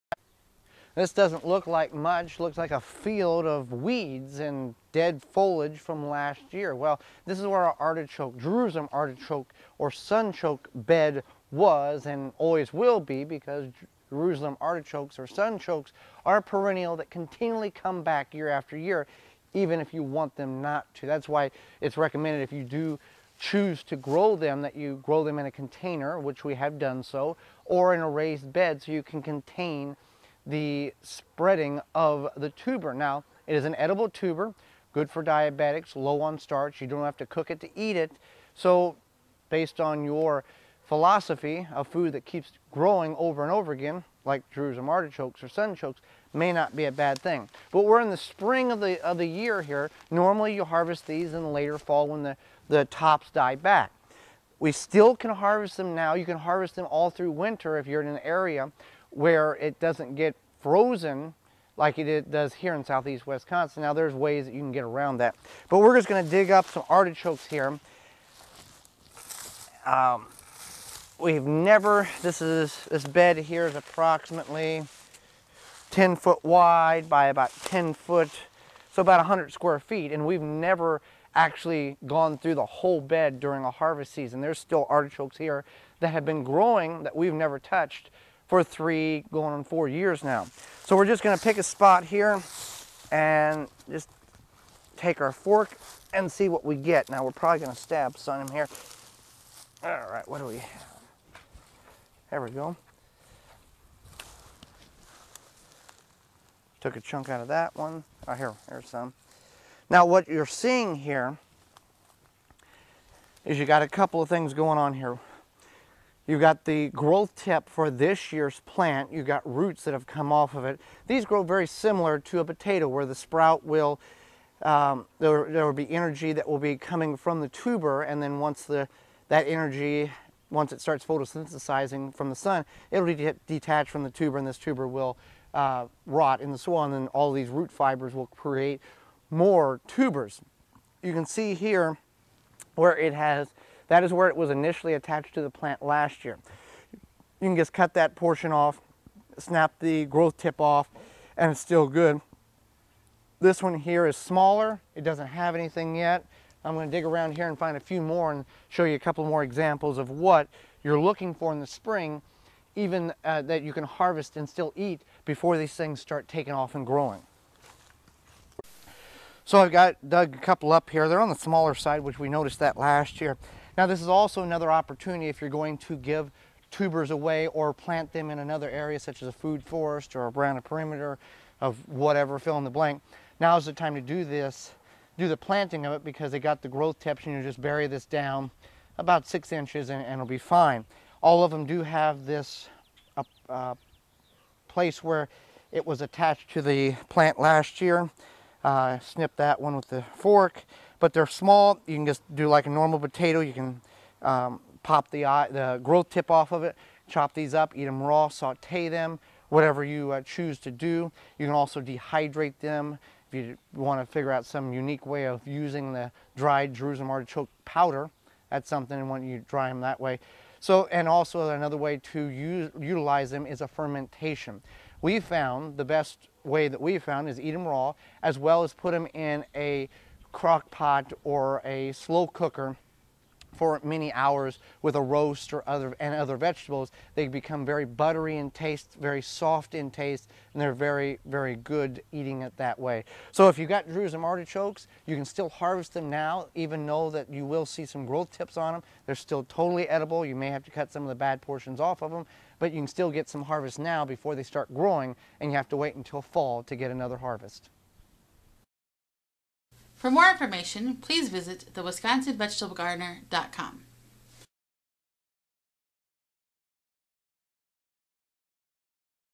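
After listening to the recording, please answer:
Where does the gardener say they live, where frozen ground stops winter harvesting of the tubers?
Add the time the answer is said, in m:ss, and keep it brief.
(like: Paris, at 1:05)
southeast Wisconsin, at 1:02.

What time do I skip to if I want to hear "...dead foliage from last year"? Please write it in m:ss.
0:04.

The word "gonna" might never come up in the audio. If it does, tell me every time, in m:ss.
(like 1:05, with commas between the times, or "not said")
1:06, 1:31, 1:37, 2:36.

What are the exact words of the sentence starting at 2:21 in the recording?
You can see here where it has that is where it was initially attached to the plant last year.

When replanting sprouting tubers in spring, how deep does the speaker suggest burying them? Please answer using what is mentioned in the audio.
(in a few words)
6 inches.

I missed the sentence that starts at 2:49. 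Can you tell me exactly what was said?
So I've got dug a couple up here.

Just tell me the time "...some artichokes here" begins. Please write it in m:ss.
1:06.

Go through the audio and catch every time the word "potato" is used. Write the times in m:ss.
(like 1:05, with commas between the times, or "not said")
2:02, 3:22.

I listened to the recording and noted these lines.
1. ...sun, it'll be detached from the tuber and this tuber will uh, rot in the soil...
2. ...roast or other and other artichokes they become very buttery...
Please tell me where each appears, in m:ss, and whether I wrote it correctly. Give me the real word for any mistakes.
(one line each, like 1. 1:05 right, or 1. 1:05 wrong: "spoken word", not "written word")
1. 2:12 right
2. 3:55 wrong: "vegetables", not "artichokes".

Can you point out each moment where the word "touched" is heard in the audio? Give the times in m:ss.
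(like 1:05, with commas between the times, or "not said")
1:27.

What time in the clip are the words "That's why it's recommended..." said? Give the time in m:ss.
0:21.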